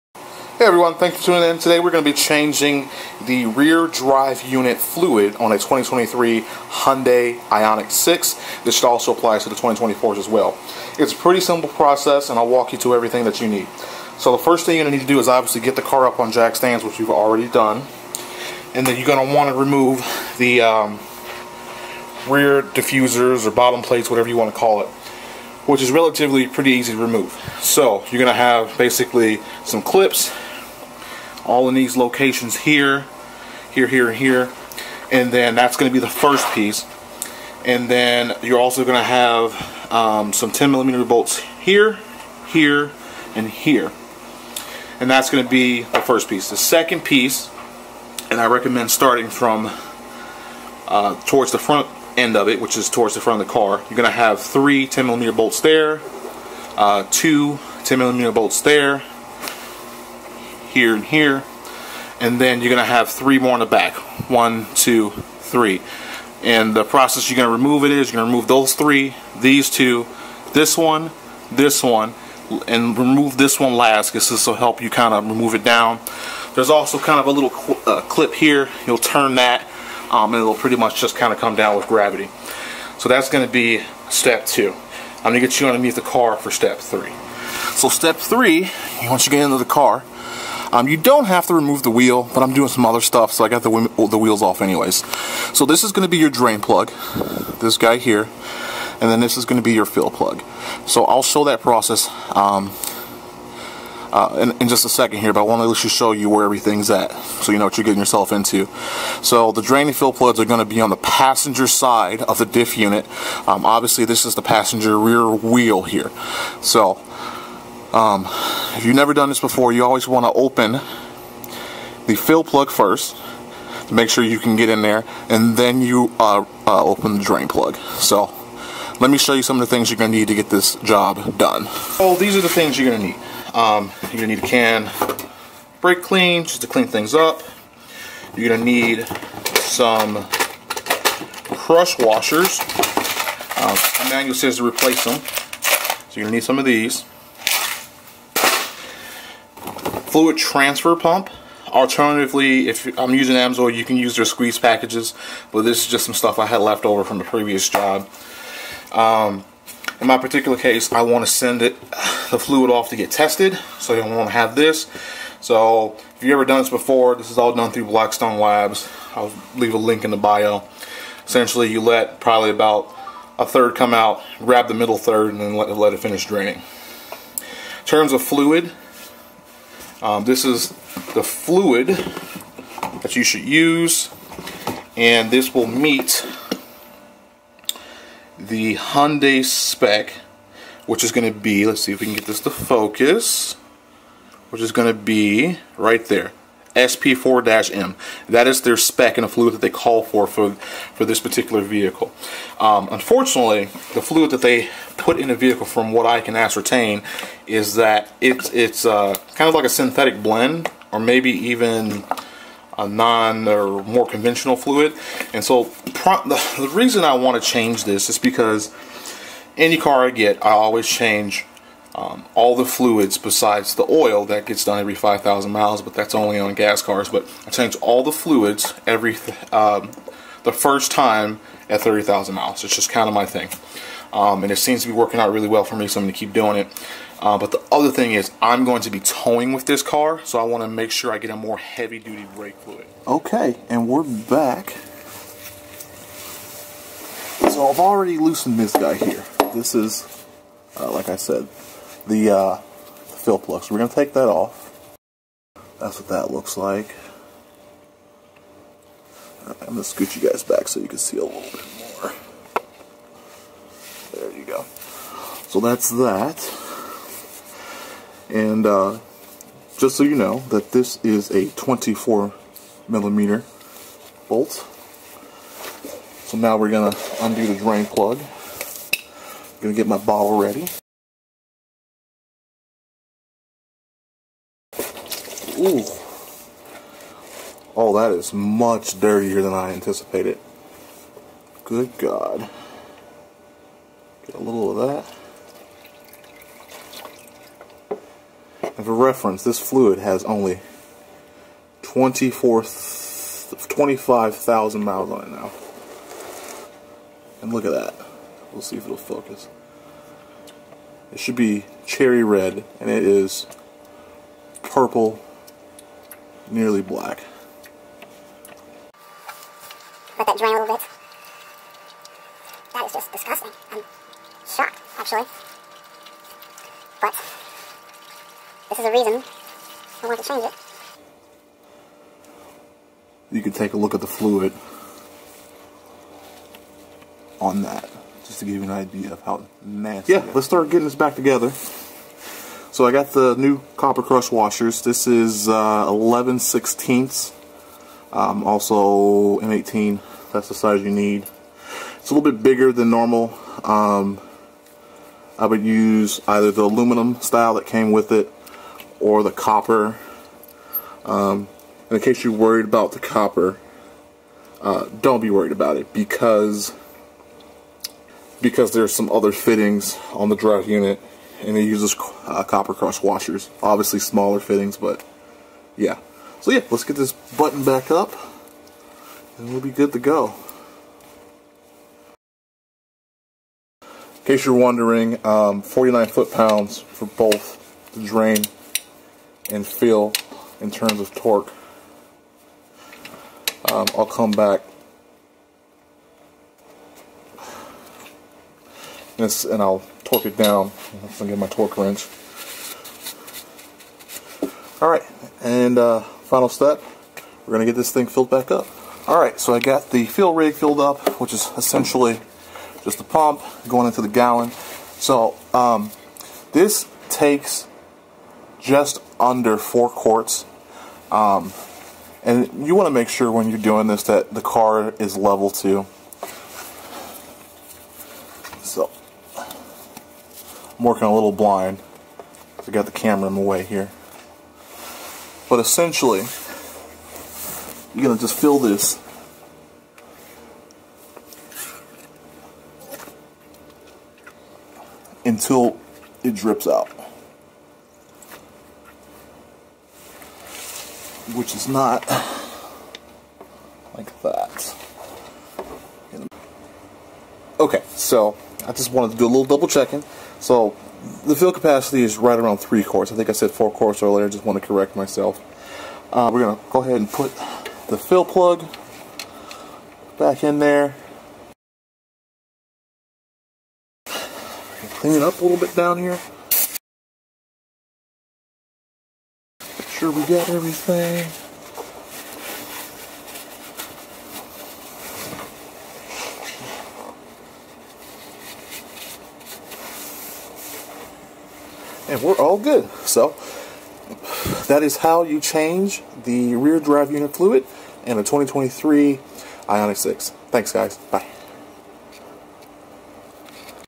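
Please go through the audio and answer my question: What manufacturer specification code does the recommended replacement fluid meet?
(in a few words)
SP4-M.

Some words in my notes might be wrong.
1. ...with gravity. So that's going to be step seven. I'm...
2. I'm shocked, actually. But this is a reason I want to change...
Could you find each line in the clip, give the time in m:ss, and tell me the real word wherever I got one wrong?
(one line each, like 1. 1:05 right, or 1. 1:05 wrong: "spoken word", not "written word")
1. 1:21 wrong: "two", not "seven"
2. 5:23 right.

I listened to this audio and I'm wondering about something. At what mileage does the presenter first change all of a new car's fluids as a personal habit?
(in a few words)
30,000 miles.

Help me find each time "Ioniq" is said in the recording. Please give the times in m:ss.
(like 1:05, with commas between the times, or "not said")
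0:07, 8:19.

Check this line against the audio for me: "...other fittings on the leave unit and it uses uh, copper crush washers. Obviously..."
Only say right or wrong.
wrong.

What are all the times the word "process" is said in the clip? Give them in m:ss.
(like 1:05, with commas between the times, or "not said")
0:11, 1:06, 1:41.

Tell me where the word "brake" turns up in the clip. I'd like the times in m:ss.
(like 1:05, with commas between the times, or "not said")
2:15, 4:02.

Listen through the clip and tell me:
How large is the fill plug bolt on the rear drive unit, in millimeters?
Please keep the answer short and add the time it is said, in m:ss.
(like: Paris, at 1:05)
24 millimeter, at 4:31.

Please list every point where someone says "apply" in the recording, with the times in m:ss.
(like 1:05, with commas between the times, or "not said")
0:09.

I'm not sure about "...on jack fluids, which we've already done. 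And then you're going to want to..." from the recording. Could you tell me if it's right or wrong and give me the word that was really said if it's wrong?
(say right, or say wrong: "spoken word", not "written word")
wrong: "stands", not "fluids".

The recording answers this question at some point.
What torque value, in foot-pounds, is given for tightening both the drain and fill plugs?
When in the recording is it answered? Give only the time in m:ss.
6:25.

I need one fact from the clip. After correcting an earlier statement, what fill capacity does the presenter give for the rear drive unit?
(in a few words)
3 quarts.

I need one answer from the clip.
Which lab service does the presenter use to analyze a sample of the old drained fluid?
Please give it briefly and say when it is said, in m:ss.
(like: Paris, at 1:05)
Blackstone Labs, at 2:47.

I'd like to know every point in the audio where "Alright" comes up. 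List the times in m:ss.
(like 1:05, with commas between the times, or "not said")
6:44, 6:49.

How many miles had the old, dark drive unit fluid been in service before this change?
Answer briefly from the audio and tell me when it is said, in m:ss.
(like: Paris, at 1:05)
25,000 miles, at 5:01.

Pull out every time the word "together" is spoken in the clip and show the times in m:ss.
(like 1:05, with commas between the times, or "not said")
5:41.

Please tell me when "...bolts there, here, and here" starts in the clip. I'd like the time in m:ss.
0:58.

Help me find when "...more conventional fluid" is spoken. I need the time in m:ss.
3:33.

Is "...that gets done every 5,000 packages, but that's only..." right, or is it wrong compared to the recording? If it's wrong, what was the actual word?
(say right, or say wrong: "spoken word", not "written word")
wrong: "miles", not "packages".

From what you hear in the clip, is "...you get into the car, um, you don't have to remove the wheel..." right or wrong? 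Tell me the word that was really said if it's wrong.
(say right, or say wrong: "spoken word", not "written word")
right.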